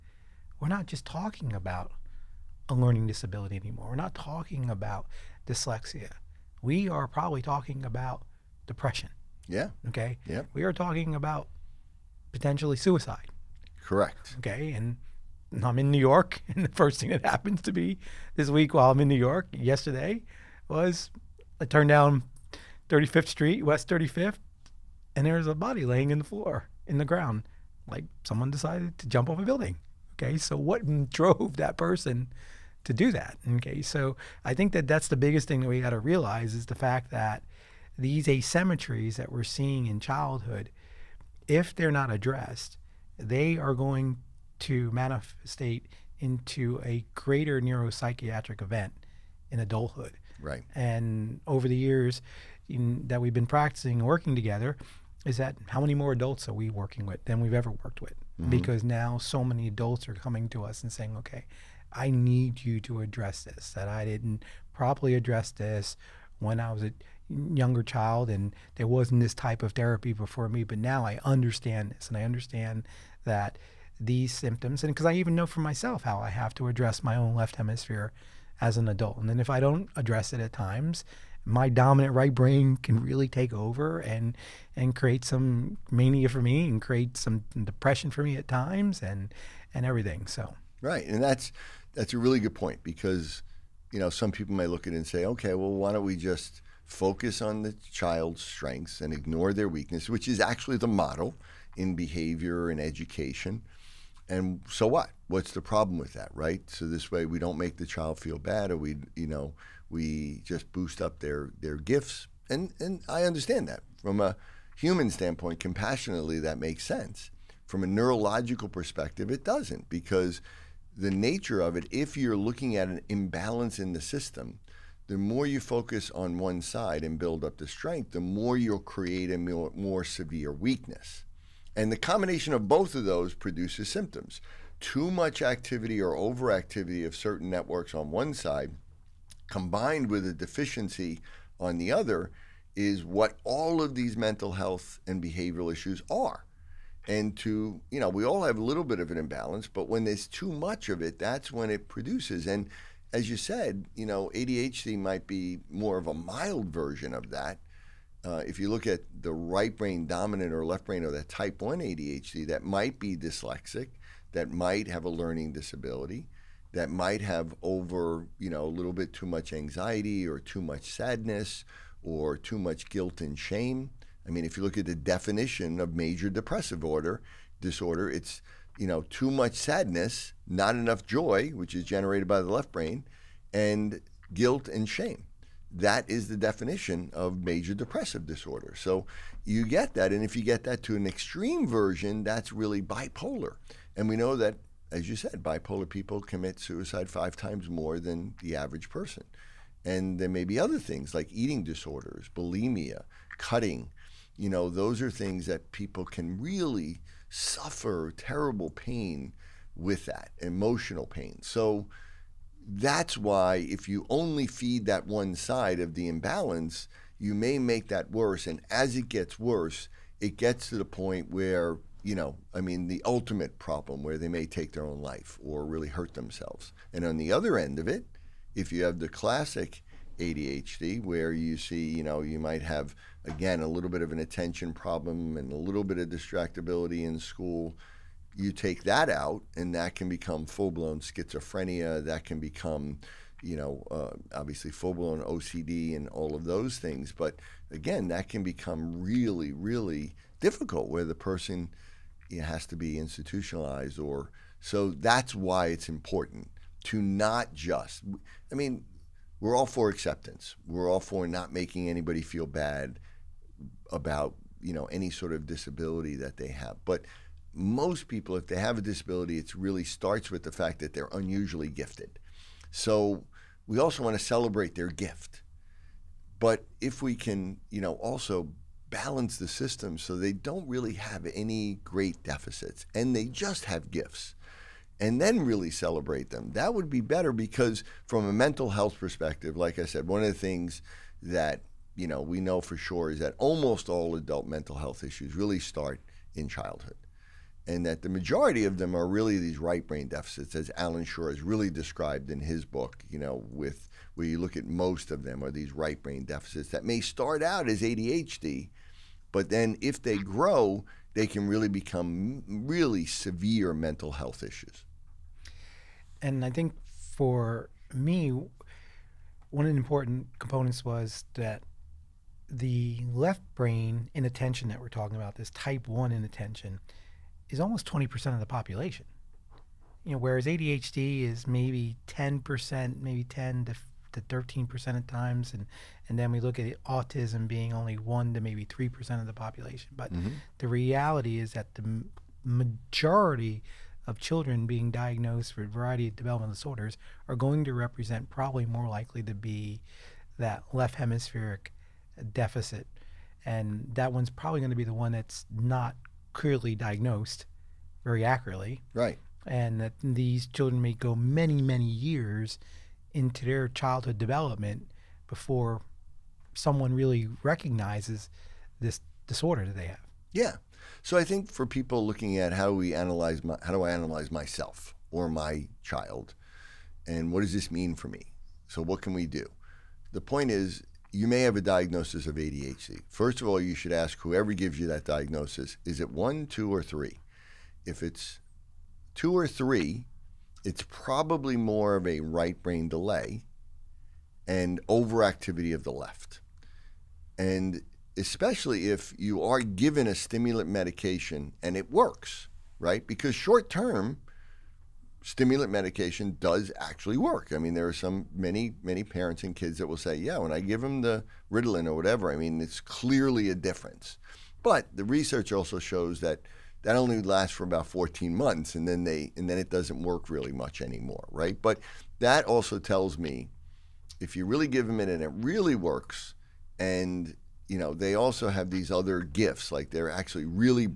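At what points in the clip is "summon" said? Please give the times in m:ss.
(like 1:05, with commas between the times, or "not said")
not said.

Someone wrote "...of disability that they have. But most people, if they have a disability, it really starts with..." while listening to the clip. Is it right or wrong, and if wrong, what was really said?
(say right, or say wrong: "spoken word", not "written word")
right.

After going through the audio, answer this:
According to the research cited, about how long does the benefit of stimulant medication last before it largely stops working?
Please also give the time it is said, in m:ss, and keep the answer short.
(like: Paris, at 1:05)
14 months, at 6:57.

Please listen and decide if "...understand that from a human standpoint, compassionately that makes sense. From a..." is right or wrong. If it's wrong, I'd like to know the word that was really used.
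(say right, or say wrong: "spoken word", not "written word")
right.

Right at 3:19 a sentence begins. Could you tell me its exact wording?
And there may be other things like eating disorders, bulimia, cutting.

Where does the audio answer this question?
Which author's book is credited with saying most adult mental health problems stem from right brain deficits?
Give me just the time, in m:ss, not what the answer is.
5:00.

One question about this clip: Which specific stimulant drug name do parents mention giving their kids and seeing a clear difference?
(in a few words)
Ritalin.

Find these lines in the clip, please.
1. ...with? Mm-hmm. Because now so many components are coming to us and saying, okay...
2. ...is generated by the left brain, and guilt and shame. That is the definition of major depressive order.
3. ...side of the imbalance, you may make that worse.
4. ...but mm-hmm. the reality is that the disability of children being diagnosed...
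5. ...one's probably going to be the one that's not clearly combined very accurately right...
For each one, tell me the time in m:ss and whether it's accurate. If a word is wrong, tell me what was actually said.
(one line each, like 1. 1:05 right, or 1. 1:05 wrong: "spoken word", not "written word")
1. 0:58 wrong: "adults", not "components"
2. 3:01 wrong: "disorder", not "order"
3. 3:35 right
4. 5:39 wrong: "majority", not "disability"
5. 5:54 wrong: "diagnosed", not "combined".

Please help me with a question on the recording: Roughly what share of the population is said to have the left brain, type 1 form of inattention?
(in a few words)
20%.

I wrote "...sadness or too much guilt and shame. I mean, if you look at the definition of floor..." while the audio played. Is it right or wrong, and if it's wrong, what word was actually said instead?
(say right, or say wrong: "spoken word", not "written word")
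wrong: "major", not "floor".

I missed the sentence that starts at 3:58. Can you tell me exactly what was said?
You take that out, and that can become full blown schizophrenia.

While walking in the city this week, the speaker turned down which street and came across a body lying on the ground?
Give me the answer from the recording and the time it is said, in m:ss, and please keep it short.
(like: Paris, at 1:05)
West 35th, at 0:23.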